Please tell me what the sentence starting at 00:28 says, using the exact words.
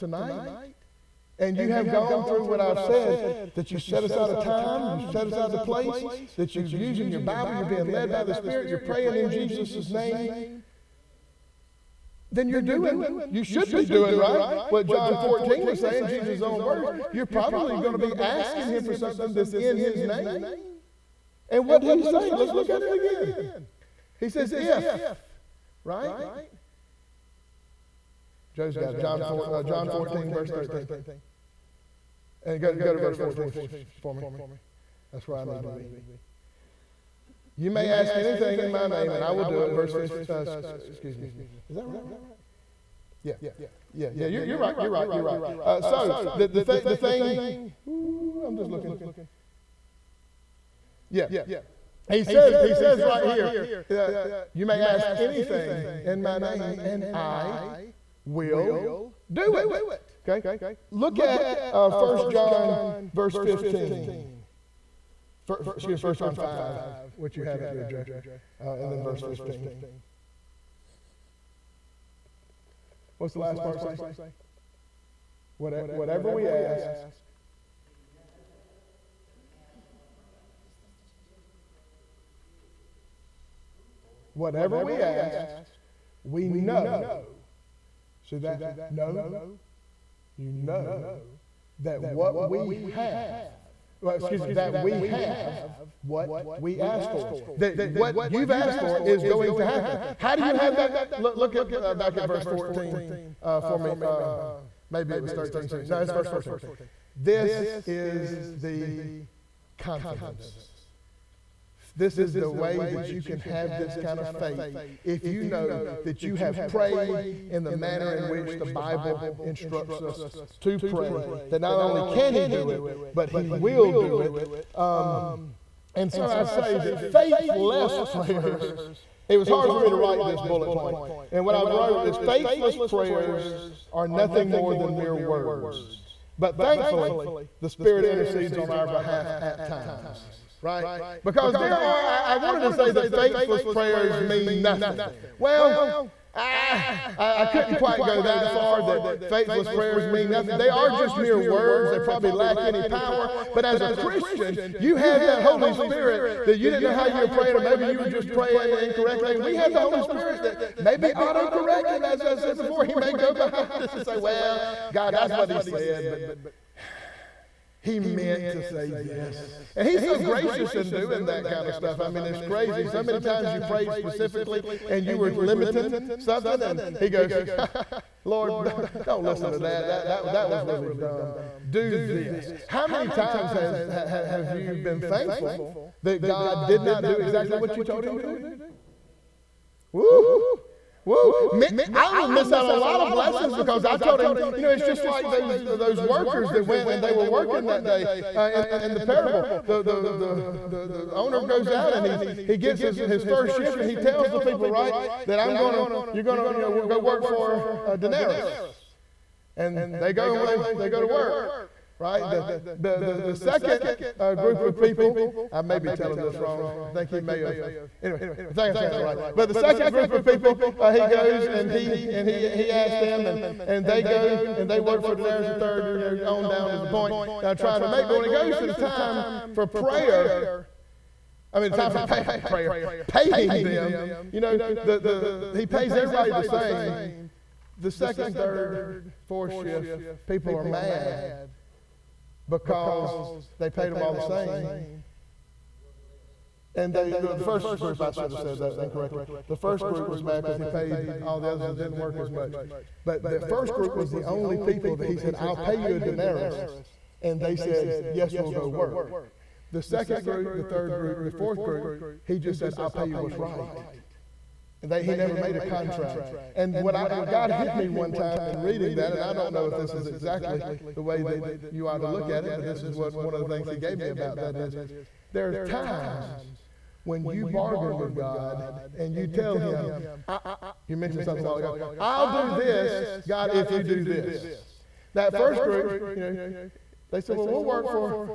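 John, 4, uh, John 14, verse 13.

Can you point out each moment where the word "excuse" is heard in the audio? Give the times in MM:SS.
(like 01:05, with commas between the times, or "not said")
00:40, 01:05, 01:34.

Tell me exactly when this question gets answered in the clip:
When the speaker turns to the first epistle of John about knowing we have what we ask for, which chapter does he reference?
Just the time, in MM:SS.
01:06.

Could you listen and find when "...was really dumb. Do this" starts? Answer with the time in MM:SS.
03:00.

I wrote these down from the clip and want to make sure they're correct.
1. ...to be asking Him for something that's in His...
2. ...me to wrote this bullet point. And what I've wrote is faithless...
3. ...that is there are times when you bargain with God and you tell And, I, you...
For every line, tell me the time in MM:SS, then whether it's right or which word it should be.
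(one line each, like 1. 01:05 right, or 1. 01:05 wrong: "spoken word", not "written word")
1. 00:17 right
2. 02:09 wrong: "write", not "wrote"
3. 04:34 wrong: "Him", not "And".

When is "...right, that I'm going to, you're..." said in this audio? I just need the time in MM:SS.
03:24.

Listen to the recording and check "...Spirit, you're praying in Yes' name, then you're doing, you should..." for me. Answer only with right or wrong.
wrong.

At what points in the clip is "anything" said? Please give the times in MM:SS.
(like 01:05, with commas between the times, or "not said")
00:38, 00:55.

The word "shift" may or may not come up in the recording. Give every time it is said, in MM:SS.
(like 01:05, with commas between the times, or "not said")
03:23, 03:59.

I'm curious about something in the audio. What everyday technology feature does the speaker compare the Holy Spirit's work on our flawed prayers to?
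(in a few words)
auto correcting.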